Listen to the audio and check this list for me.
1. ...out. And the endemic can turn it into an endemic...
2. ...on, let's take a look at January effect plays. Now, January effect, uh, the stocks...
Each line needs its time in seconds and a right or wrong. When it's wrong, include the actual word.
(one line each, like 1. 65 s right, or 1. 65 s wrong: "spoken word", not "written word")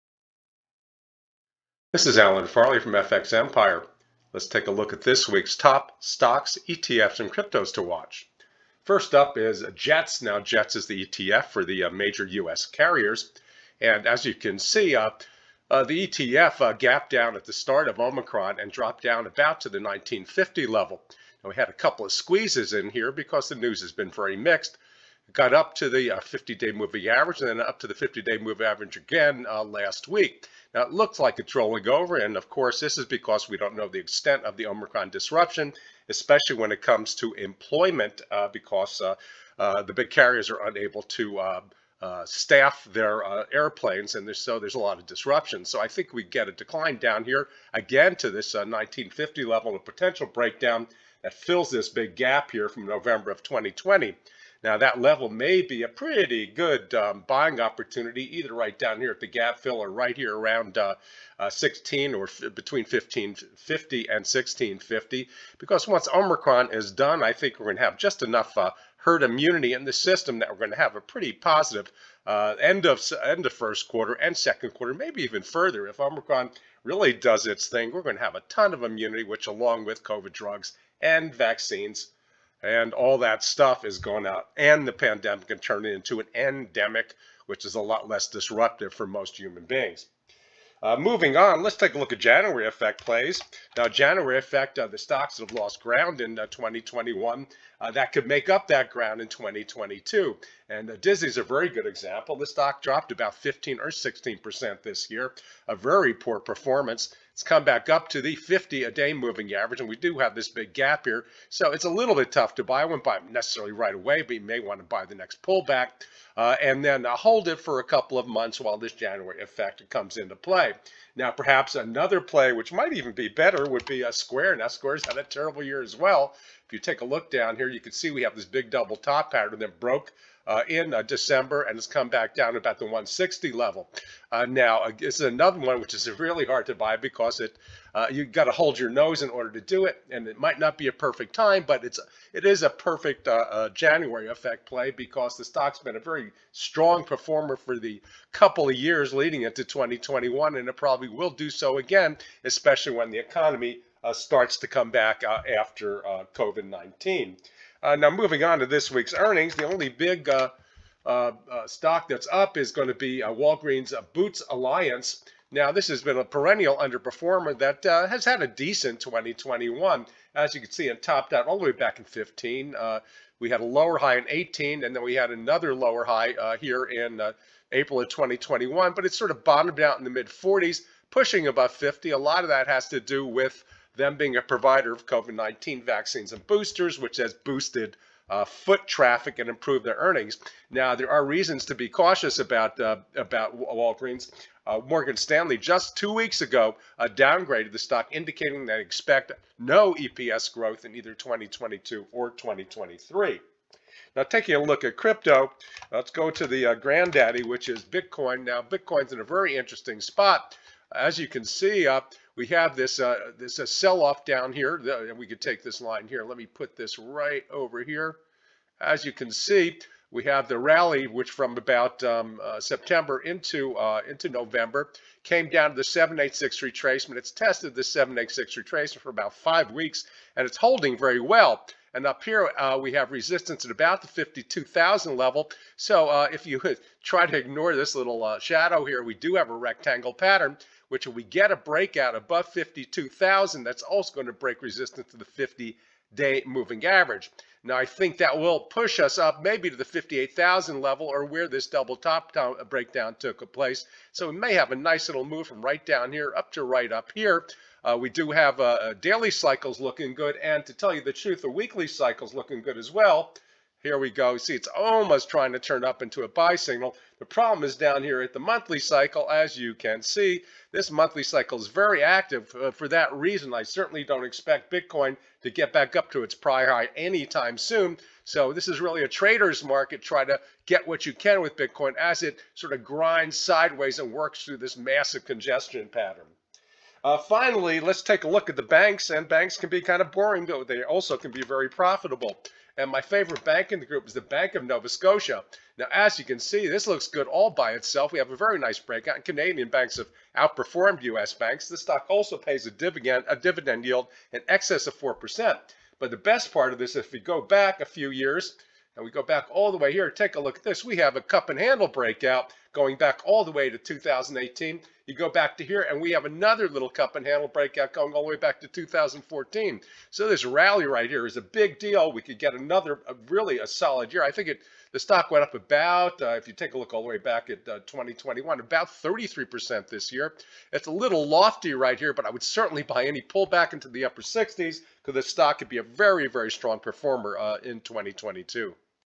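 1. 84 s wrong: "pandemic", not "endemic"
2. 91 s right.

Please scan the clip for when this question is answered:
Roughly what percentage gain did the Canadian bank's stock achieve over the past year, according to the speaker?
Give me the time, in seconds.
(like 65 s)
328 s.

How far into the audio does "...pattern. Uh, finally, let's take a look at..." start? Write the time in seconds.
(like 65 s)
285 s.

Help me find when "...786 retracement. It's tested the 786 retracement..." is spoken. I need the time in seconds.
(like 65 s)
225 s.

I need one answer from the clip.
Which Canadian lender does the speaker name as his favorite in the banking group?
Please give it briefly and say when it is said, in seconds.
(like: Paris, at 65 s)
Bank of Nova Scotia, at 294 s.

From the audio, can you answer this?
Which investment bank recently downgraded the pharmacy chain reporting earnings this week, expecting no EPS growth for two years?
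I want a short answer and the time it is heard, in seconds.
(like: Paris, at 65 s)
Morgan Stanley, at 194 s.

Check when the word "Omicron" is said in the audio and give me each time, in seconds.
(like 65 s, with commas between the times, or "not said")
17 s, 34 s, 66 s, 75 s.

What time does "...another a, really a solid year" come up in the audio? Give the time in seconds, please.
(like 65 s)
322 s.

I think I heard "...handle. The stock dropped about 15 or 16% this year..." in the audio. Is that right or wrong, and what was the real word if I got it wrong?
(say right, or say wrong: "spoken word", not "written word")
wrong: "example", not "handle".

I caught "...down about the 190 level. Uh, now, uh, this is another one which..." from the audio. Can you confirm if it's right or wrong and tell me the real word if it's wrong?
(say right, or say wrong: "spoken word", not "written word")
wrong: "160", not "190".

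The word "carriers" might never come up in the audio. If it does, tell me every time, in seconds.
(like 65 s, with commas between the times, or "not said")
12 s, 40 s.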